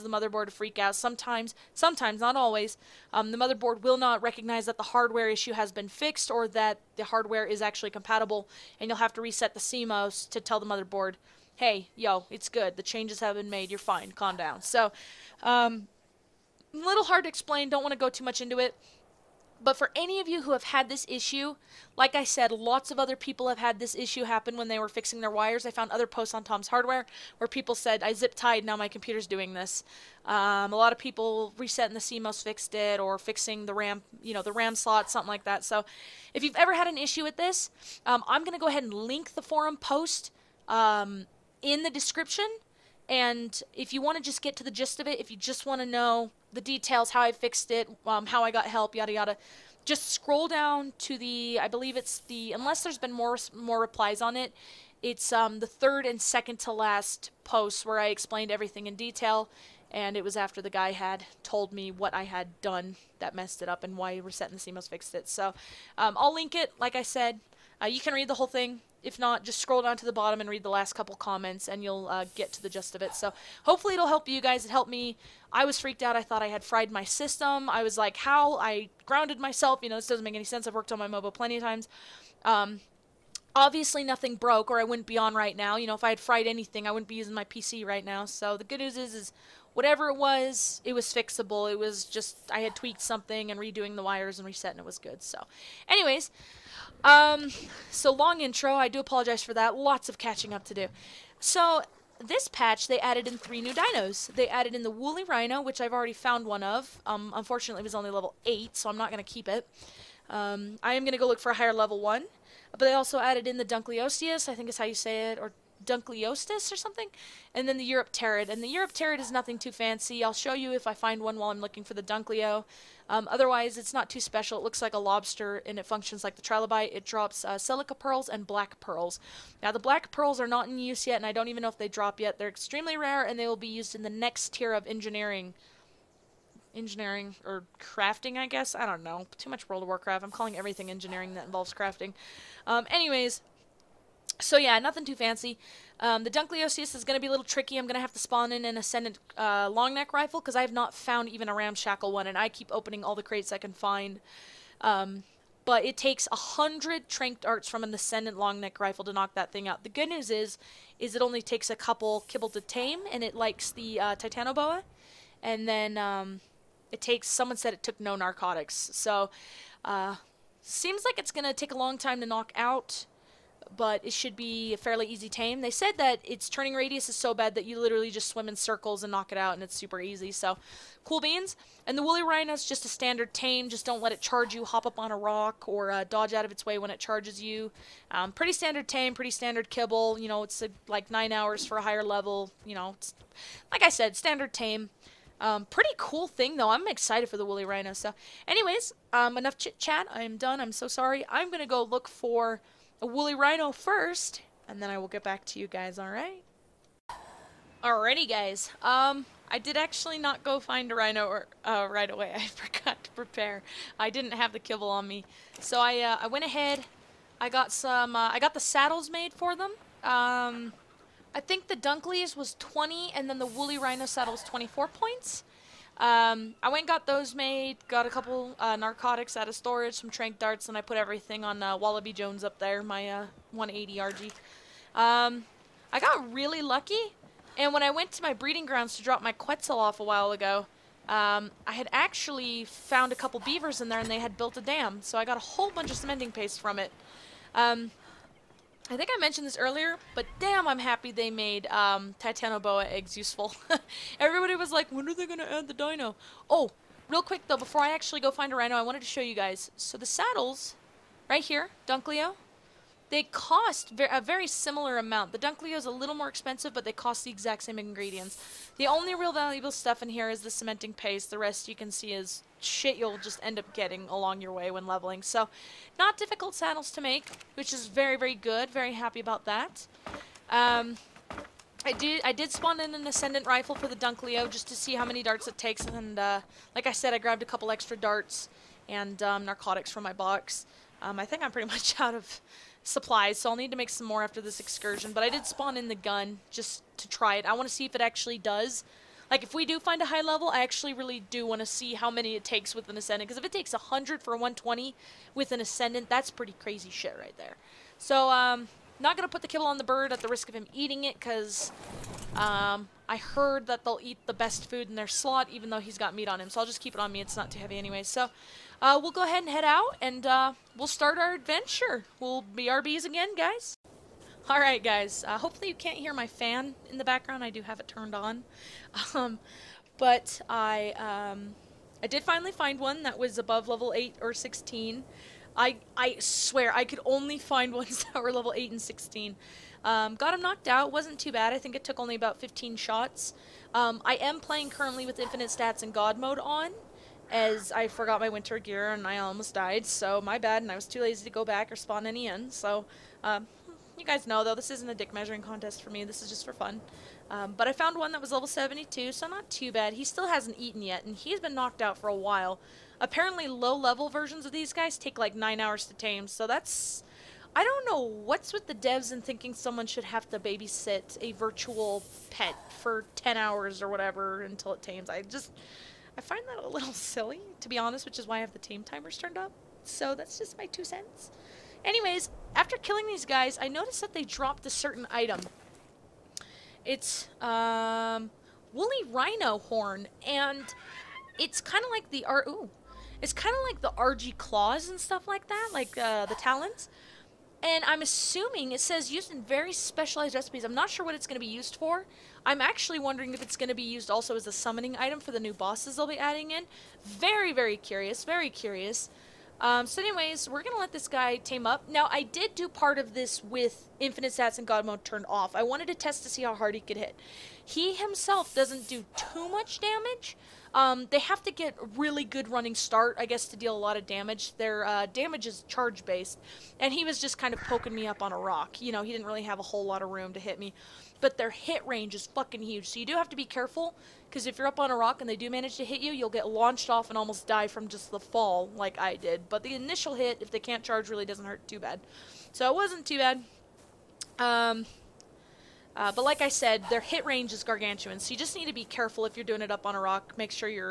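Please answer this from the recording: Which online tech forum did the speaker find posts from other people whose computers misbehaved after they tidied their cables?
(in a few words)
Tom's Hardware.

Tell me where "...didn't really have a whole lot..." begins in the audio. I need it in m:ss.
7:09.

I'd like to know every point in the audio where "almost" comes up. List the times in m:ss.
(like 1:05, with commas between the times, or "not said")
5:49, 7:17.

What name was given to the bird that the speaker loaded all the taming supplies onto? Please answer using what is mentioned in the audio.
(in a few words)
Wallaby Jones.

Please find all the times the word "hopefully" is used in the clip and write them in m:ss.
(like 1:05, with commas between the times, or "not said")
1:13, 5:25.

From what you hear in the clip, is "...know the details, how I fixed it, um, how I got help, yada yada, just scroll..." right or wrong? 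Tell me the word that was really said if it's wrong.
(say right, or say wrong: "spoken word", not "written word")
right.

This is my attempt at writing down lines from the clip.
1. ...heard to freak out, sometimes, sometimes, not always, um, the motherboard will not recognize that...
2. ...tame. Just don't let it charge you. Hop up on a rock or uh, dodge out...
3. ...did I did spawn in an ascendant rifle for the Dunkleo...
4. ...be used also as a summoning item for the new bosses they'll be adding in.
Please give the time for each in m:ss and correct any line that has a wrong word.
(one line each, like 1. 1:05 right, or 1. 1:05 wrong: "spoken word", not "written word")
1. 0:00 wrong: "motherboard", not "heard"
2. 3:03 right
3. 4:41 right
4. 6:43 right.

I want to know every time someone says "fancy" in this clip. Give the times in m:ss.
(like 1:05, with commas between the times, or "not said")
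1:59, 2:25.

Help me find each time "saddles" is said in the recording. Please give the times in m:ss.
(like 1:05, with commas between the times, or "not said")
3:38, 3:44, 4:20, 4:36.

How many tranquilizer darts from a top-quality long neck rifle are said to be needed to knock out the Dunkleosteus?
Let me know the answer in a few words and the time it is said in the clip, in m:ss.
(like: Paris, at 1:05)
100, at 2:36.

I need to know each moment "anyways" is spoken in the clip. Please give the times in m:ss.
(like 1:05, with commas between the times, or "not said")
1:35, 2:22, 3:18, 5:17, 6:21, 6:50.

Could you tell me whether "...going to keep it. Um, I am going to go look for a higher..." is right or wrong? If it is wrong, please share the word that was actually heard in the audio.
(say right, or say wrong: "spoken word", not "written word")
right.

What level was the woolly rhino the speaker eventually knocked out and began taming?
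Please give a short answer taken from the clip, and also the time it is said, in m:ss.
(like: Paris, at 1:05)
72, at 5:58.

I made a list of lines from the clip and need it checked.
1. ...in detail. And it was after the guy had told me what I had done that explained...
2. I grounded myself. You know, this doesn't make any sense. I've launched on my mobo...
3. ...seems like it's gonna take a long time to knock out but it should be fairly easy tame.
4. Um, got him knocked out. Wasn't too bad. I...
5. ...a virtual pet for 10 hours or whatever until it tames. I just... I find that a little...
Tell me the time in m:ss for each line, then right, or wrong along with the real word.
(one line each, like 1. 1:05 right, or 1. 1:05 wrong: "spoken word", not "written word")
1. 0:58 wrong: "messed", not "explained"
2. 1:18 wrong: "worked", not "launched"
3. 2:50 right
4. 5:39 right
5. 6:11 right.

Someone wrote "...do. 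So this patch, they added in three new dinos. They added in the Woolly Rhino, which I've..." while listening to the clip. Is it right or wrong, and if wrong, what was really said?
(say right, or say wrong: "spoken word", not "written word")
right.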